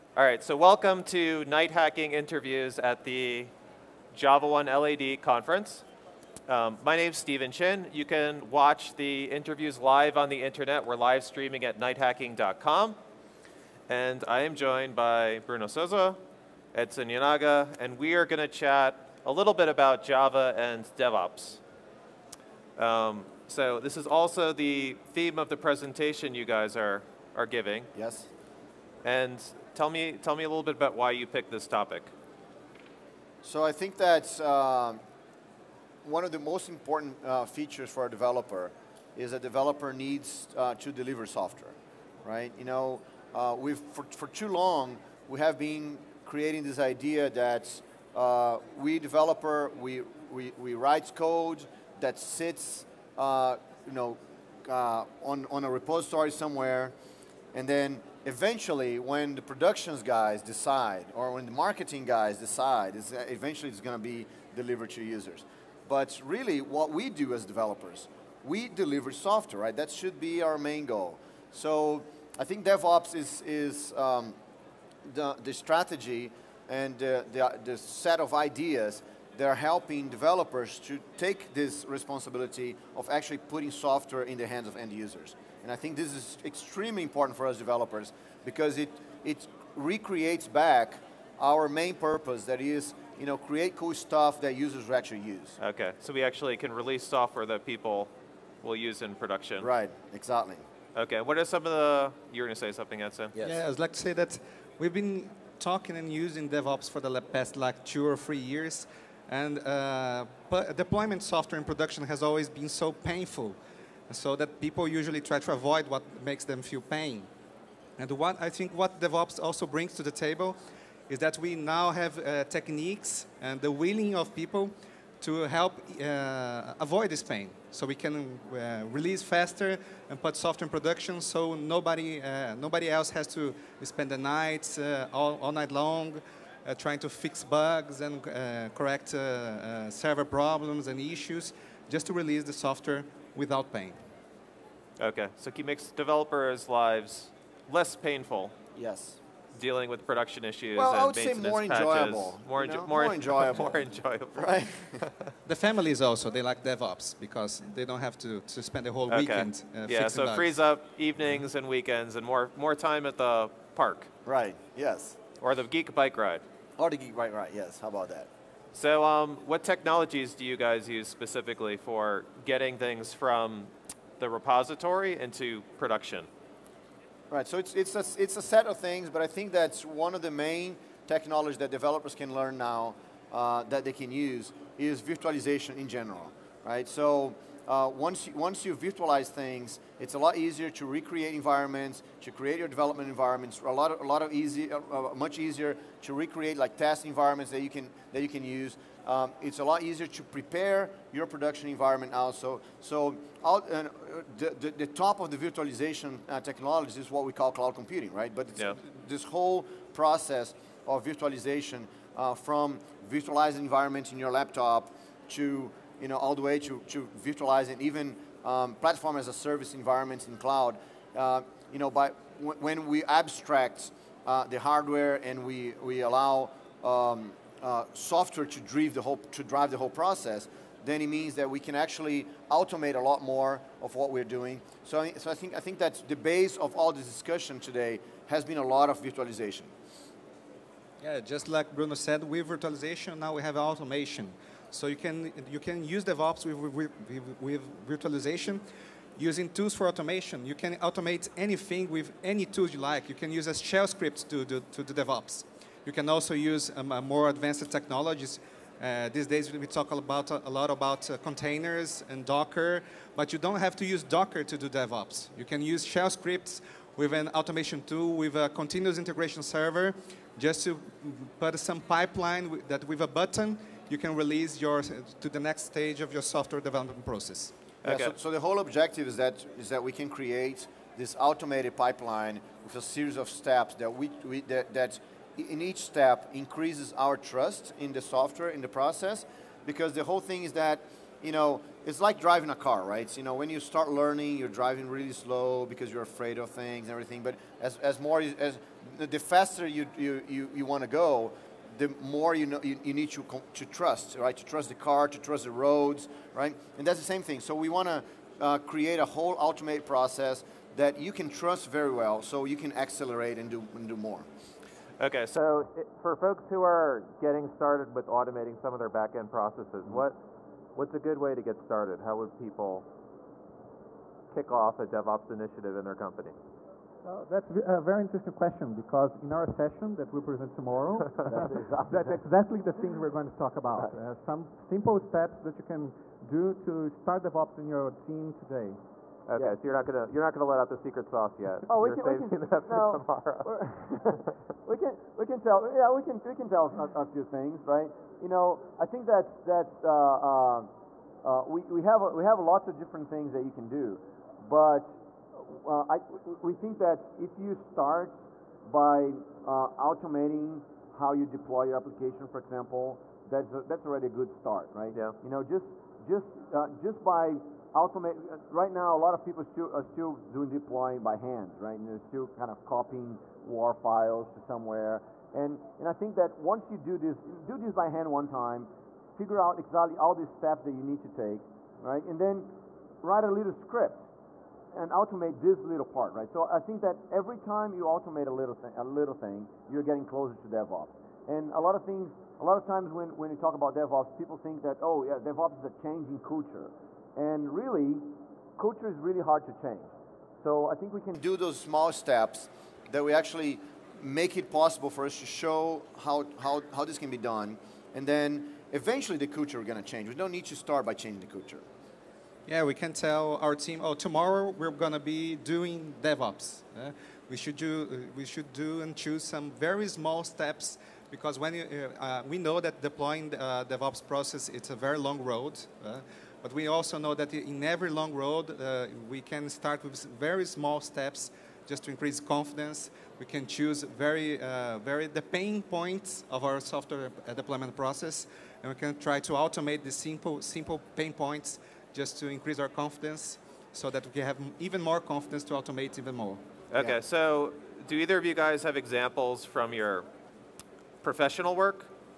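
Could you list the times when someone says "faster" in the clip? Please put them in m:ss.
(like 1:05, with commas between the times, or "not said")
2:09, 4:59.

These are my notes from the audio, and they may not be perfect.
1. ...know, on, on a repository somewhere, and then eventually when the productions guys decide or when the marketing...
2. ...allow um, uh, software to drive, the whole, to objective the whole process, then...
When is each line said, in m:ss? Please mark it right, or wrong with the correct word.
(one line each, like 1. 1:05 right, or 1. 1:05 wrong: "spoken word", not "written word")
1. 0:53 right
2. 3:45 wrong: "drive", not "objective".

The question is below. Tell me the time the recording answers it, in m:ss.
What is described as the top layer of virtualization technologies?
3:27.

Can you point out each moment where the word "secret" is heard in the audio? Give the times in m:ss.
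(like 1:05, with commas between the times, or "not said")
5:40.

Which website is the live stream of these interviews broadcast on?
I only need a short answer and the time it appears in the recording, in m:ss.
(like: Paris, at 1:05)
nighthacking.com, at 0:11.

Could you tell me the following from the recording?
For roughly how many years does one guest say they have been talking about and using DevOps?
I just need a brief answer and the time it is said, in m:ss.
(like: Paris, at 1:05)
2 or 3 years, at 1:47.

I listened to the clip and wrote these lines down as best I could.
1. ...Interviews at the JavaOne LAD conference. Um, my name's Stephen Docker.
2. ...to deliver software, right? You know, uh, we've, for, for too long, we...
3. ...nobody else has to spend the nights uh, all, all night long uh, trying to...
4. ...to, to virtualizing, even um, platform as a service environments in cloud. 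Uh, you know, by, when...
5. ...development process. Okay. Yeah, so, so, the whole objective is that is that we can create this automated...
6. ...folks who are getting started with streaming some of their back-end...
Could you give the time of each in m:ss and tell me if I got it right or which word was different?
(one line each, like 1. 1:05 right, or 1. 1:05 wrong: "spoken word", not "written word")
1. 0:02 wrong: "Chin", not "Docker"
2. 0:40 right
3. 2:12 right
4. 3:36 right
5. 4:36 right
6. 5:16 wrong: "automating", not "streaming".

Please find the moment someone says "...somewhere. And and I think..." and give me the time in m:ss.
6:14.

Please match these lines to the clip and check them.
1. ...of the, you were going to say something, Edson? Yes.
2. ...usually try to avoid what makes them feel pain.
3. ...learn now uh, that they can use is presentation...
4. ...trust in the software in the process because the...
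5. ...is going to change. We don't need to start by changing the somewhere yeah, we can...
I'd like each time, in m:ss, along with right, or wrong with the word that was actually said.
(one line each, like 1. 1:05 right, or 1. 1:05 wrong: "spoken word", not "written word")
1. 1:41 right
2. 1:54 right
3. 3:02 wrong: "virtualization", not "presentation"
4. 4:47 right
5. 6:49 wrong: "culture", not "somewhere".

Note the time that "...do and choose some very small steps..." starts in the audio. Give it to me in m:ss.
6:58.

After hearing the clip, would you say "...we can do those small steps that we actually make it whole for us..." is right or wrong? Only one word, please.
wrong.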